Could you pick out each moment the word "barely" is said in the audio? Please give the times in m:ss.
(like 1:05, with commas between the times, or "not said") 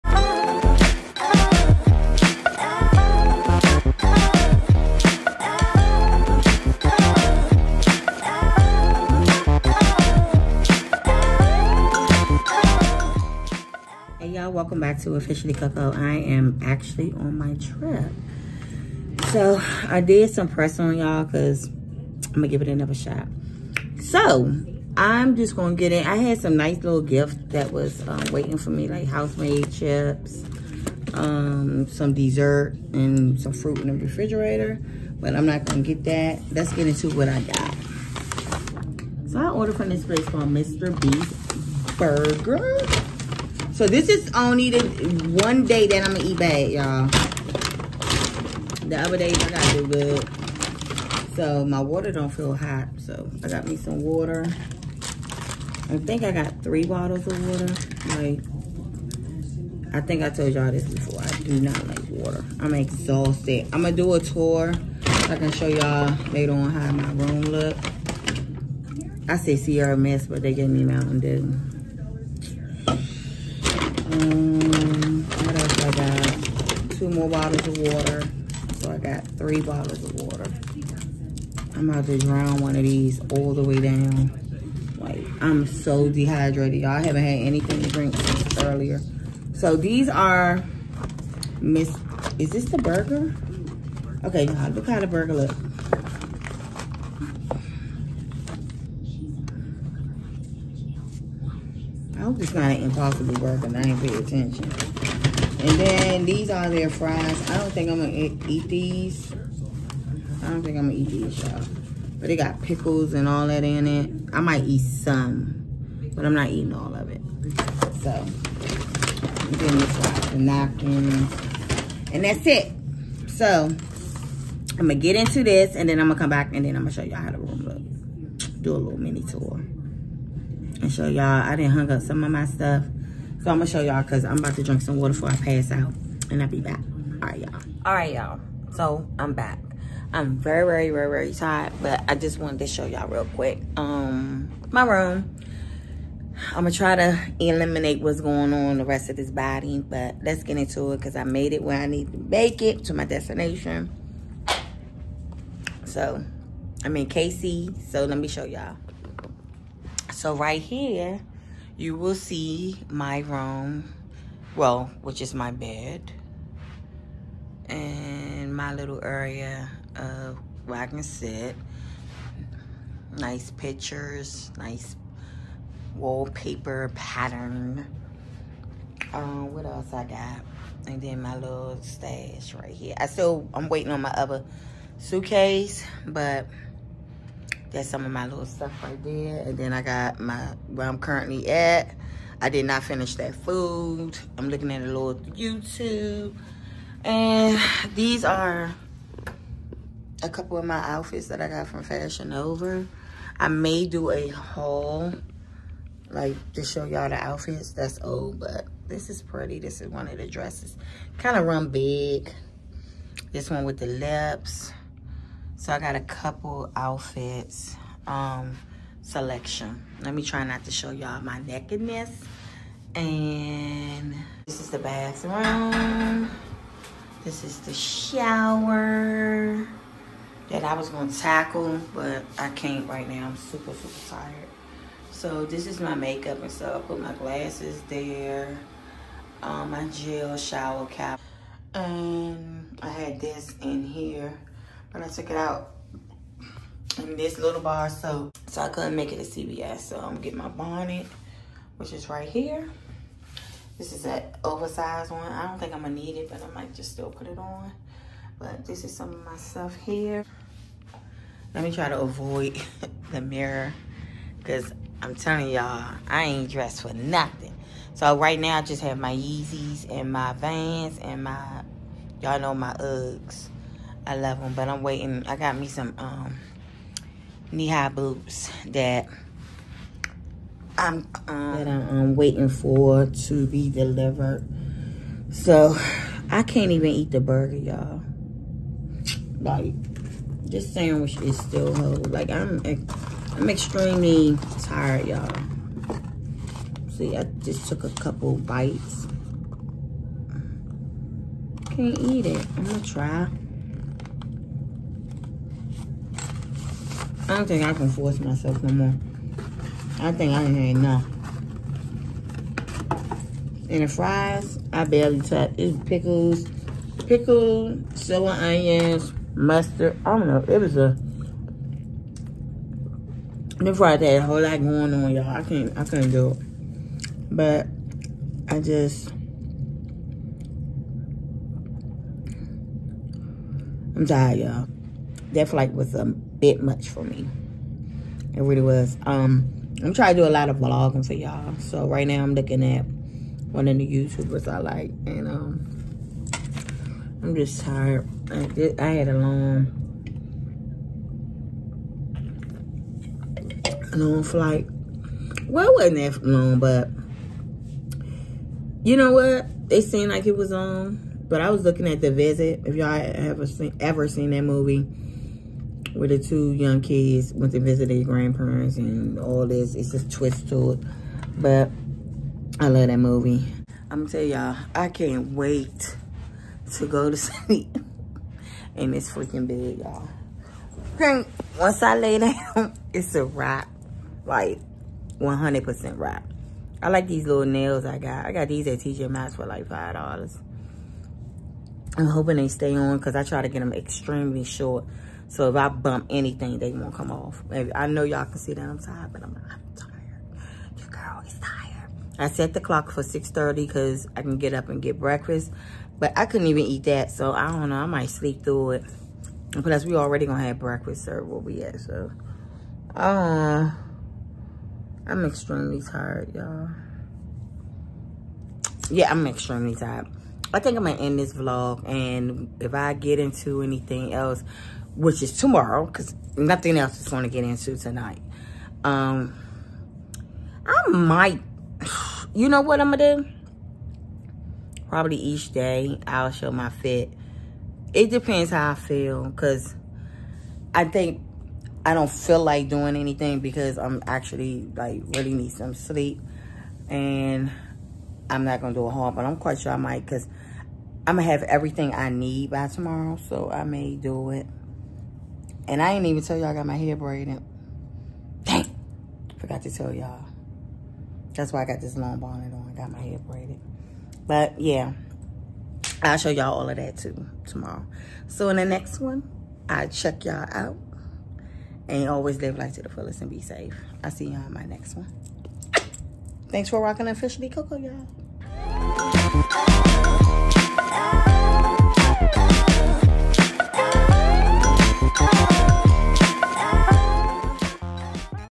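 5:14.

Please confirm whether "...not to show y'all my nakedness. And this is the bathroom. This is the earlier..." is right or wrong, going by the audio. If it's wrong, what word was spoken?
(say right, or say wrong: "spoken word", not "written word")
wrong: "shower", not "earlier".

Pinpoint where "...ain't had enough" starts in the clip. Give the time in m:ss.
5:10.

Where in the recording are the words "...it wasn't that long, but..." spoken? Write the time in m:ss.
5:55.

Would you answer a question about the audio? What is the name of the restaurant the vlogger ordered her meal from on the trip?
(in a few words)
Mr. Beef Burger.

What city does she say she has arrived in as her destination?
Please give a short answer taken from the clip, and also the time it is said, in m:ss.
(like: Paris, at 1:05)
KC, at 2:37.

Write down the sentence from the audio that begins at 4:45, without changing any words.
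So I can't even eat the burger, y'all.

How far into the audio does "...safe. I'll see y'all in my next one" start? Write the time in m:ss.
7:53.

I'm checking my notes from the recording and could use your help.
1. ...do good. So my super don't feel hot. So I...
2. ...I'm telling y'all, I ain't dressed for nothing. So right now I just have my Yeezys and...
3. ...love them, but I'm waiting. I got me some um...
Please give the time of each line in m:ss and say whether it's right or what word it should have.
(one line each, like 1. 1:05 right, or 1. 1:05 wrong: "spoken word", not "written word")
1. 0:49 wrong: "water", not "super"
2. 4:25 right
3. 4:34 right.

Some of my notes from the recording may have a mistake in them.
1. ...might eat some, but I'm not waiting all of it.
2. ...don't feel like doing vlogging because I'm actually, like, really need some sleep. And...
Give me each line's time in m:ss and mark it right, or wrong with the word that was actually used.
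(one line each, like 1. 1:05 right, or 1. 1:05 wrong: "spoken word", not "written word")
1. 1:54 wrong: "eating", not "waiting"
2. 7:21 wrong: "anything", not "vlogging".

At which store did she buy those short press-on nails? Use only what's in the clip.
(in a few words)
TJ Maxx.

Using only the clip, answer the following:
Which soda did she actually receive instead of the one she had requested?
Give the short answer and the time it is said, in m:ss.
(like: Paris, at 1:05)
Mountain Dew, at 1:10.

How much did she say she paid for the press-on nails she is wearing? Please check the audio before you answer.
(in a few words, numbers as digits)
$5.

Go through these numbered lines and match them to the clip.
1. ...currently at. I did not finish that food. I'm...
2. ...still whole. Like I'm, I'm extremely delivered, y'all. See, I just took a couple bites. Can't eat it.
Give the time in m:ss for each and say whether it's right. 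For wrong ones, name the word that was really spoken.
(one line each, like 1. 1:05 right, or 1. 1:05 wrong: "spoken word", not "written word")
1. 3:10 right
2. 4:51 wrong: "tired", not "delivered".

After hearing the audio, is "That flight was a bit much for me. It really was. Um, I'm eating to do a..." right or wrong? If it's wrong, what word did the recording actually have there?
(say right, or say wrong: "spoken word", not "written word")
wrong: "trying", not "eating".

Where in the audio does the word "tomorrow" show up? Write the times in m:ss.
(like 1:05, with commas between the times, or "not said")
7:05, 7:32, 7:47.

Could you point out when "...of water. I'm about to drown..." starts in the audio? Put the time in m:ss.
1:20.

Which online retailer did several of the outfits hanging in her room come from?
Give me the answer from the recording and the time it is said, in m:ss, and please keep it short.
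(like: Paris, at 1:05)
Fashion Nova, at 3:21.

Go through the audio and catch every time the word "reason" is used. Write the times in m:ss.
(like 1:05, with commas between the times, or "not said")
not said.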